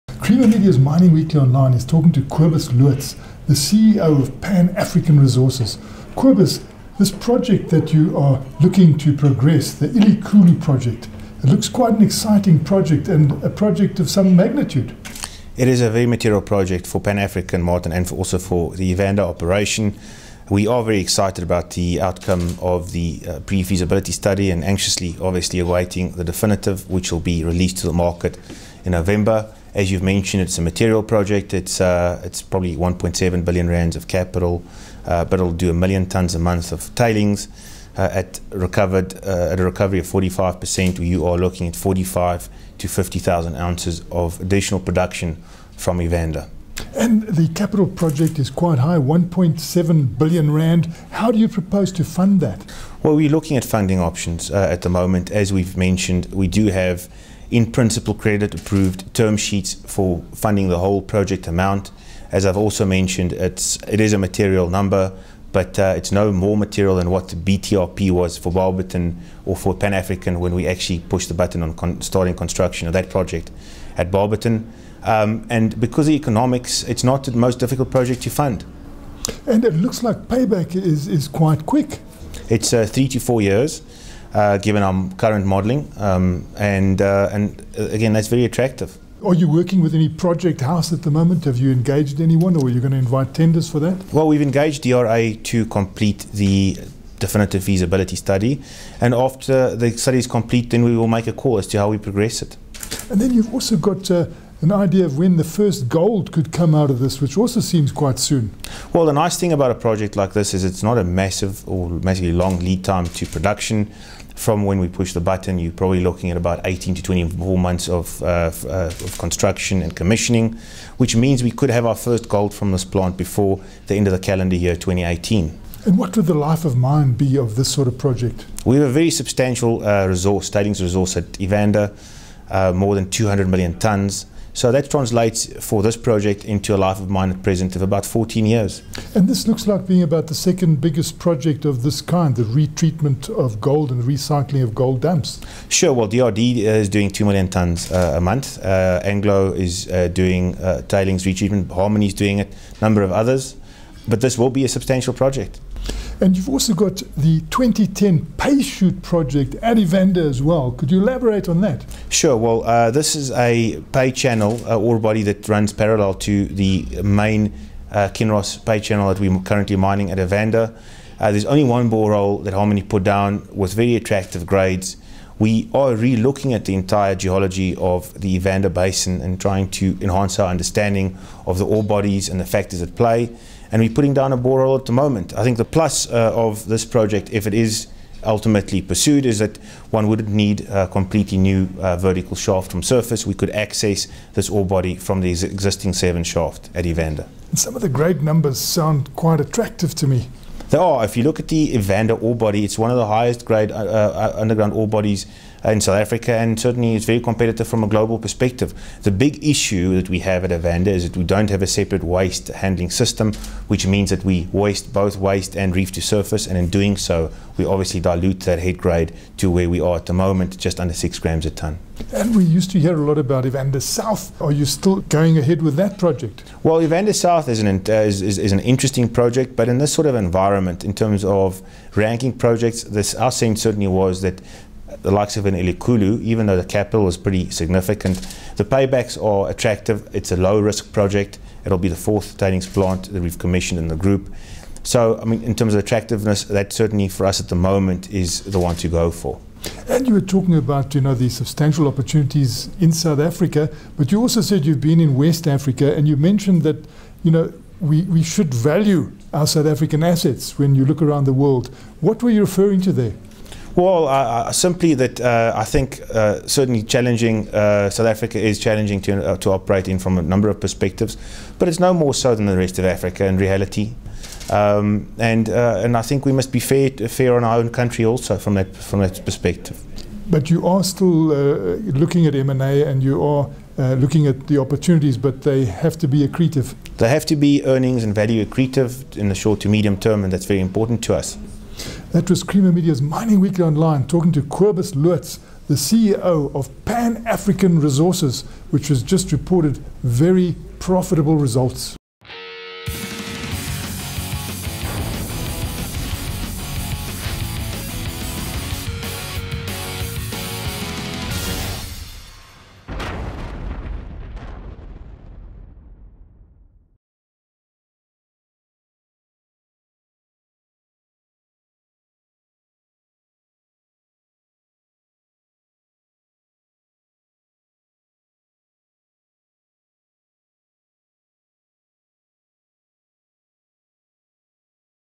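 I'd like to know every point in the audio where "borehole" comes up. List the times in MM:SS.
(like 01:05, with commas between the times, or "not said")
02:51, 03:04.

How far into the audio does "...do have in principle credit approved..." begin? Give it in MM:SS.
00:56.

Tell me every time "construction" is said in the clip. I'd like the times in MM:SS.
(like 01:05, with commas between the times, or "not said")
01:12, 01:59.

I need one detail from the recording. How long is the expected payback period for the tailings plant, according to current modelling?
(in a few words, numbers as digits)
3 to 4 years.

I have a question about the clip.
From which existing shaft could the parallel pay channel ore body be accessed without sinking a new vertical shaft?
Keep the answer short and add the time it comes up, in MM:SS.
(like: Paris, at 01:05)
Seven shaft, at 03:15.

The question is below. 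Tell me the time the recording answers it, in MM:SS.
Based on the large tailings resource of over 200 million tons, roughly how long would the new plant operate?
02:18.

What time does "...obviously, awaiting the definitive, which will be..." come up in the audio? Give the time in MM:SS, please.
00:25.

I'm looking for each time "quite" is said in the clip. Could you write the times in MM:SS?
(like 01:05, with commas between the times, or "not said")
00:11, 00:48, 01:21, 01:47, 03:19.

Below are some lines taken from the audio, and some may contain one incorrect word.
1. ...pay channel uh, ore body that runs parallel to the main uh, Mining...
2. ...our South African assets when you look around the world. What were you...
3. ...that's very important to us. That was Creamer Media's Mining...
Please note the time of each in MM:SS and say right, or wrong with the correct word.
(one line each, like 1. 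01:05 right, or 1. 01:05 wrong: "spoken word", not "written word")
1. 02:43 wrong: "Kinross", not "Mining"
2. 04:19 right
3. 04:50 right.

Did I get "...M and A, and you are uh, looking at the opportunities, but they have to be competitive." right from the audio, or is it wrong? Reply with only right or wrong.
wrong.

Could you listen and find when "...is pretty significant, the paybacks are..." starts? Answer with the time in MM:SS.
03:57.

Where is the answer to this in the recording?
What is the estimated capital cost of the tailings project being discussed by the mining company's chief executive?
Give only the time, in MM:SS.
00:32.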